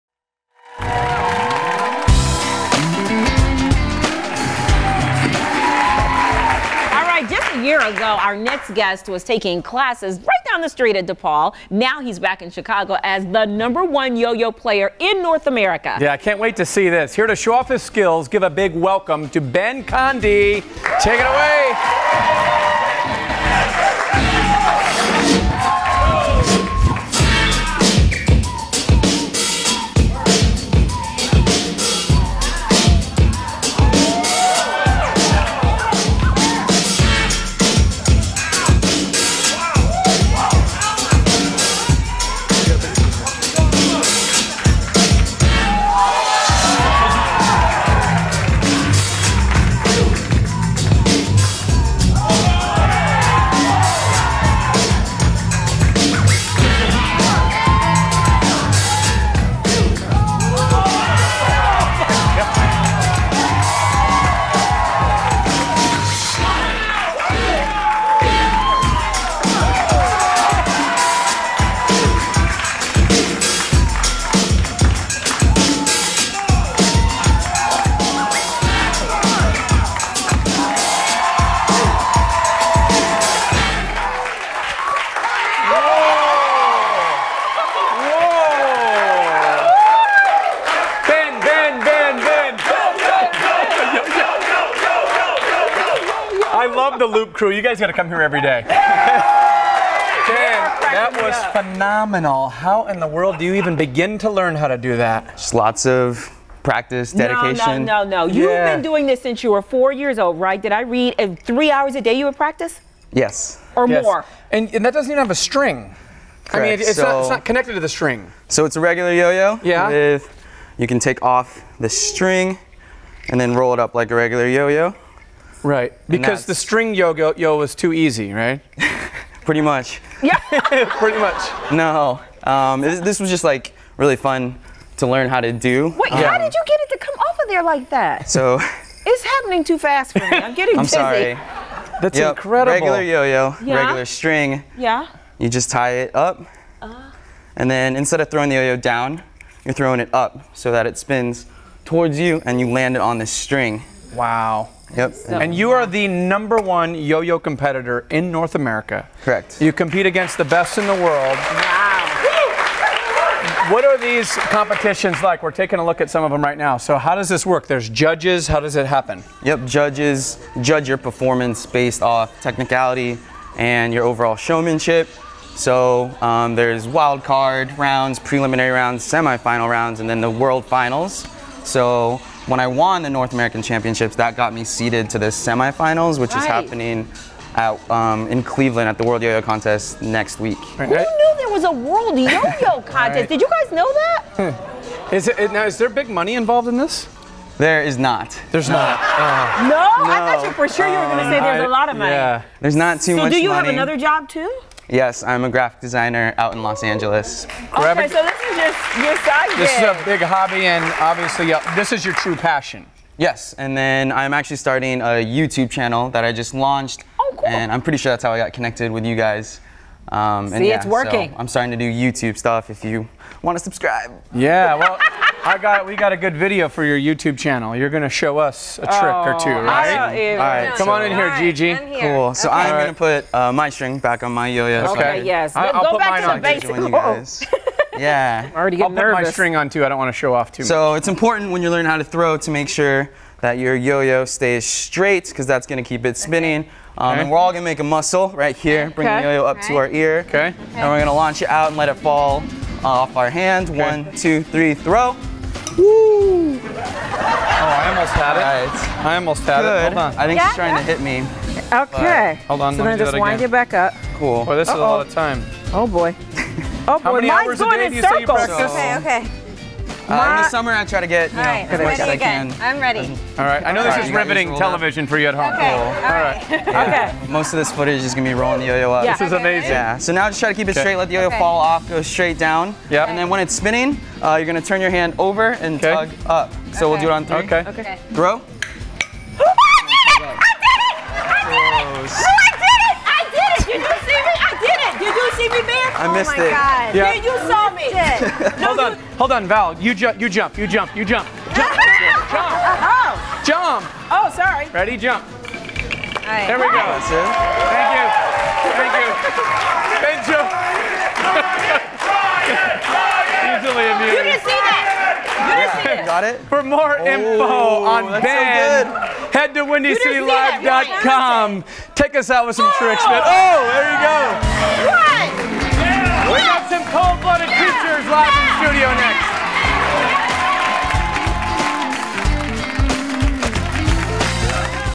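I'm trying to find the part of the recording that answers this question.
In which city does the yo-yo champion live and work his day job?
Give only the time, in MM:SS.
03:26.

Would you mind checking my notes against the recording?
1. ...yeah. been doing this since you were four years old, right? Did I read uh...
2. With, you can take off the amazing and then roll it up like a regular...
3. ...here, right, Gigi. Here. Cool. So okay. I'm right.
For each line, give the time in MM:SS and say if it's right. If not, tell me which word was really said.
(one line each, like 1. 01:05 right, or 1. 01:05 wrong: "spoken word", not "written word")
1. 01:48 right
2. 01:59 wrong: "string", not "amazing"
3. 03:51 right.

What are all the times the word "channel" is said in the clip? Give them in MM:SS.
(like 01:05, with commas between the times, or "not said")
03:35, 03:47.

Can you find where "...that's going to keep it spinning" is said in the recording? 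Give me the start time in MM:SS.
04:05.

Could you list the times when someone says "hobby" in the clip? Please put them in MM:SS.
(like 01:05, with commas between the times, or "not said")
03:30.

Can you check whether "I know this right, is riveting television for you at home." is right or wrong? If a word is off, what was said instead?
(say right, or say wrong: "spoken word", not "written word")
right.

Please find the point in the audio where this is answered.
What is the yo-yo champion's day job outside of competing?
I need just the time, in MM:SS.
03:25.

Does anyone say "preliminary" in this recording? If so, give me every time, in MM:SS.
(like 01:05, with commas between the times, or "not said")
02:58.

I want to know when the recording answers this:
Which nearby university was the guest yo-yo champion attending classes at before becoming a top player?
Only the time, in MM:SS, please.
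00:11.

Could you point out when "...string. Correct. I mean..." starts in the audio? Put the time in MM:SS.
01:55.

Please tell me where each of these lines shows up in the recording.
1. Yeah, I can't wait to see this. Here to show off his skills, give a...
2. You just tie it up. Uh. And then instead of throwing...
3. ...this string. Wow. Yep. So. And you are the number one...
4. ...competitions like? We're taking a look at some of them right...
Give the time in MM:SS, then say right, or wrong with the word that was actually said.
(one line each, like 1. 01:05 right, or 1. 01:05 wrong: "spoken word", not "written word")
1. 00:15 right
2. 02:25 right
3. 02:33 right
4. 02:44 right.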